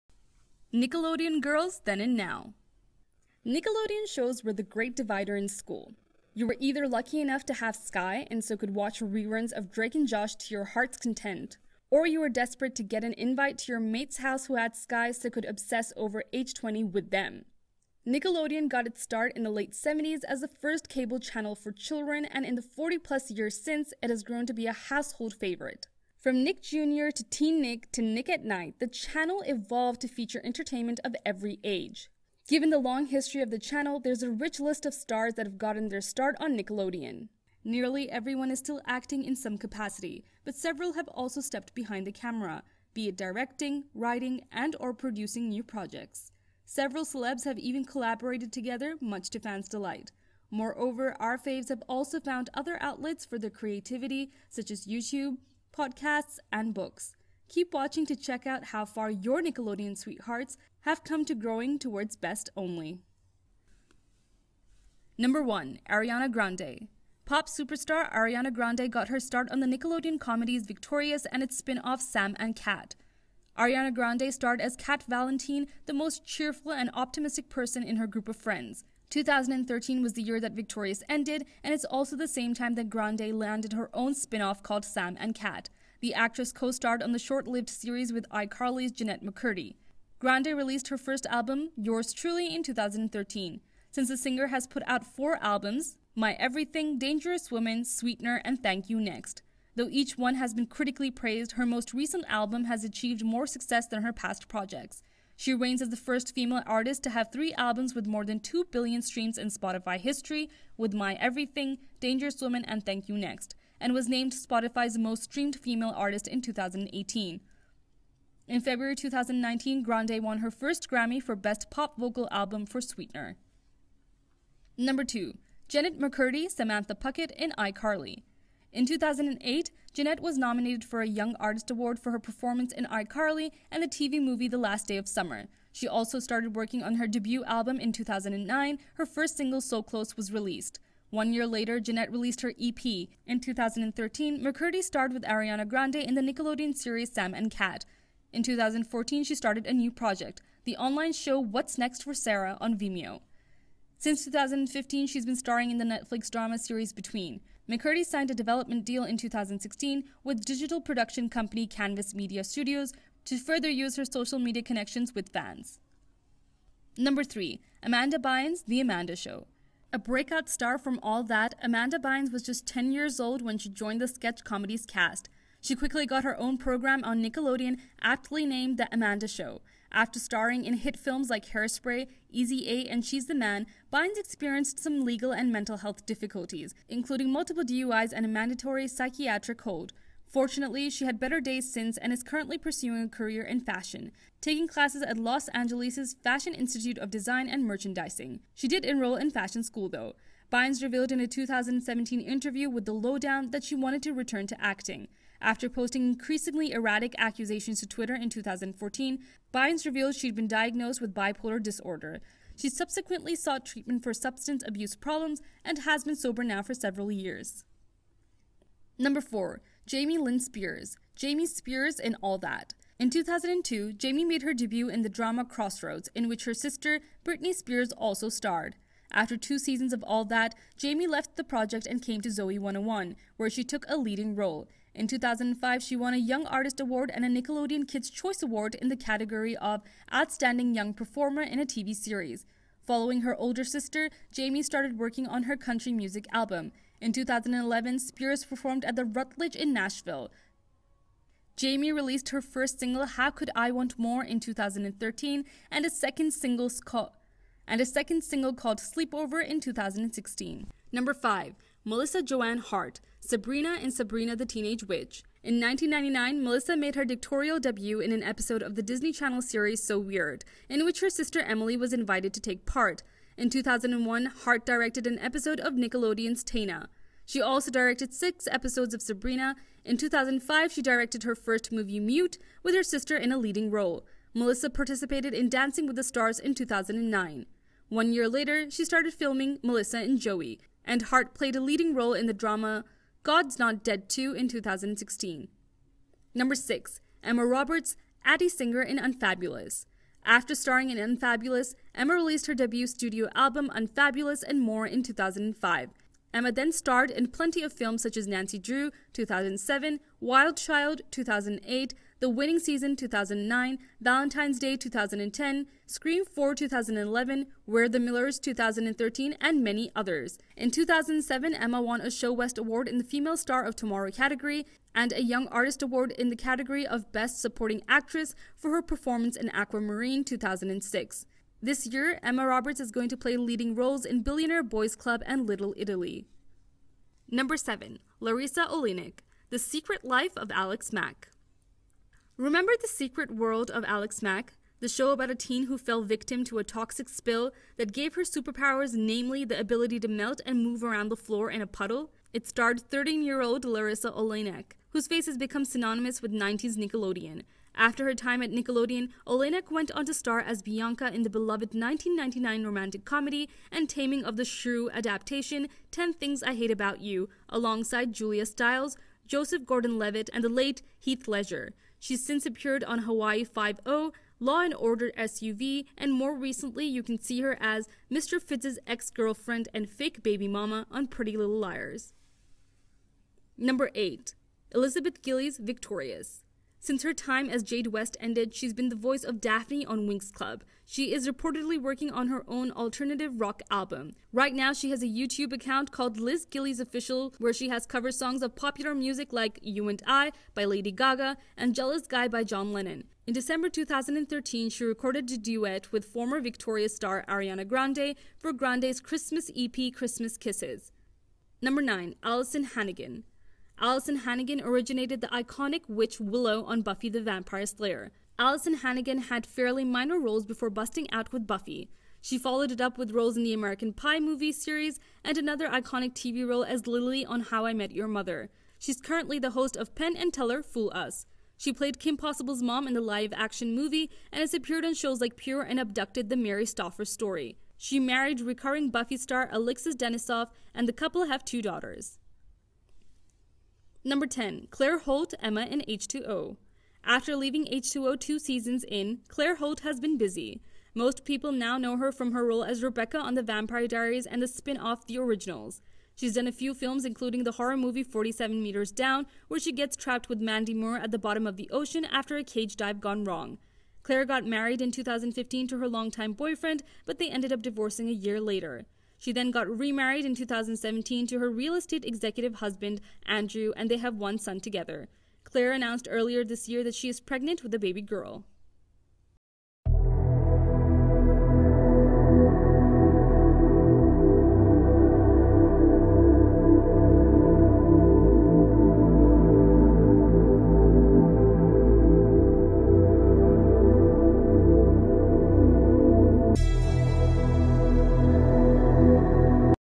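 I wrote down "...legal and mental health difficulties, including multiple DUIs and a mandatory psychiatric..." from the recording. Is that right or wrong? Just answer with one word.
right.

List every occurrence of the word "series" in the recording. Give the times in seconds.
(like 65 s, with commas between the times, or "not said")
87 s, 146 s, 156 s, 241 s, 269 s, 424 s.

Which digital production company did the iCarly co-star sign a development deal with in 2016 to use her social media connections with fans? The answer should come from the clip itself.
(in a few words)
Canvas Media Studios.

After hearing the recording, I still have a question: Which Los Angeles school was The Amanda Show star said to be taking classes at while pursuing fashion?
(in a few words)
Fashion Institute of Design and Merchandising.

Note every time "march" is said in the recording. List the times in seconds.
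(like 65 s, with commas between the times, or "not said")
not said.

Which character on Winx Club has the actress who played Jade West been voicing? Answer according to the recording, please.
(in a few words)
Daphne.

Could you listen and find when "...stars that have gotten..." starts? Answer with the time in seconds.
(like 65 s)
34 s.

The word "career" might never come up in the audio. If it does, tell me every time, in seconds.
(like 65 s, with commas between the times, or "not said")
193 s.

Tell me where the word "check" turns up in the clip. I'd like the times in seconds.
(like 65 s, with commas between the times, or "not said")
58 s.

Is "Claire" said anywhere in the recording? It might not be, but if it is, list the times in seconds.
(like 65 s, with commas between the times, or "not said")
444 s, 449 s, 464 s, 475 s.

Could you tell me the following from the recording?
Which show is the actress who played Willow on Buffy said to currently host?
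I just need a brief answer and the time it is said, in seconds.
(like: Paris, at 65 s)
Penn and Teller Fool Us, at 429 s.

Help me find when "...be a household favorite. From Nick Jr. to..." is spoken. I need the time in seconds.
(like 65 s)
24 s.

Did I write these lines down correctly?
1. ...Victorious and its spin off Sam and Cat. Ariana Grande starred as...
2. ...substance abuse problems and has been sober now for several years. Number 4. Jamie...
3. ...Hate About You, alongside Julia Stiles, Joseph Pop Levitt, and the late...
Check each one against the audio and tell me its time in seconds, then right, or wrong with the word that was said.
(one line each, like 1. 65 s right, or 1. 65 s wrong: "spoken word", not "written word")
1. 70 s right
2. 214 s right
3. 366 s wrong: "Gordon", not "Pop".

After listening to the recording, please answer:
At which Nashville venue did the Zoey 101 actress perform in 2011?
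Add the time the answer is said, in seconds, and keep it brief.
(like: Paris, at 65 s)
the Rutledge, at 248 s.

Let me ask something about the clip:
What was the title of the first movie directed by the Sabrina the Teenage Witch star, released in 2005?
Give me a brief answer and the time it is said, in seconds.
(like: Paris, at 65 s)
Mute, at 282 s.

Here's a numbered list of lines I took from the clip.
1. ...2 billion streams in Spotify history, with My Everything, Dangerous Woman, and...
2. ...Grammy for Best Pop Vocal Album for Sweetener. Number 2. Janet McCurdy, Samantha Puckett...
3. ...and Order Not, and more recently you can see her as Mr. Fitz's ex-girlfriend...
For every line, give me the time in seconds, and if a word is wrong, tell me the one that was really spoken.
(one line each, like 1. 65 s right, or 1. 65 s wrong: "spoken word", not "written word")
1. 108 s right
2. 120 s right
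3. 374 s wrong: "SVU", not "Not".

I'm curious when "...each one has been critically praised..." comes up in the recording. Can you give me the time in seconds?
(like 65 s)
99 s.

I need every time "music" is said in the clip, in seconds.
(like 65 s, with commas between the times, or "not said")
245 s, 398 s.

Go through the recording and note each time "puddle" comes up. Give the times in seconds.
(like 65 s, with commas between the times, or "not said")
351 s.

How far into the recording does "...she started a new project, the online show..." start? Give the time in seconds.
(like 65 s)
149 s.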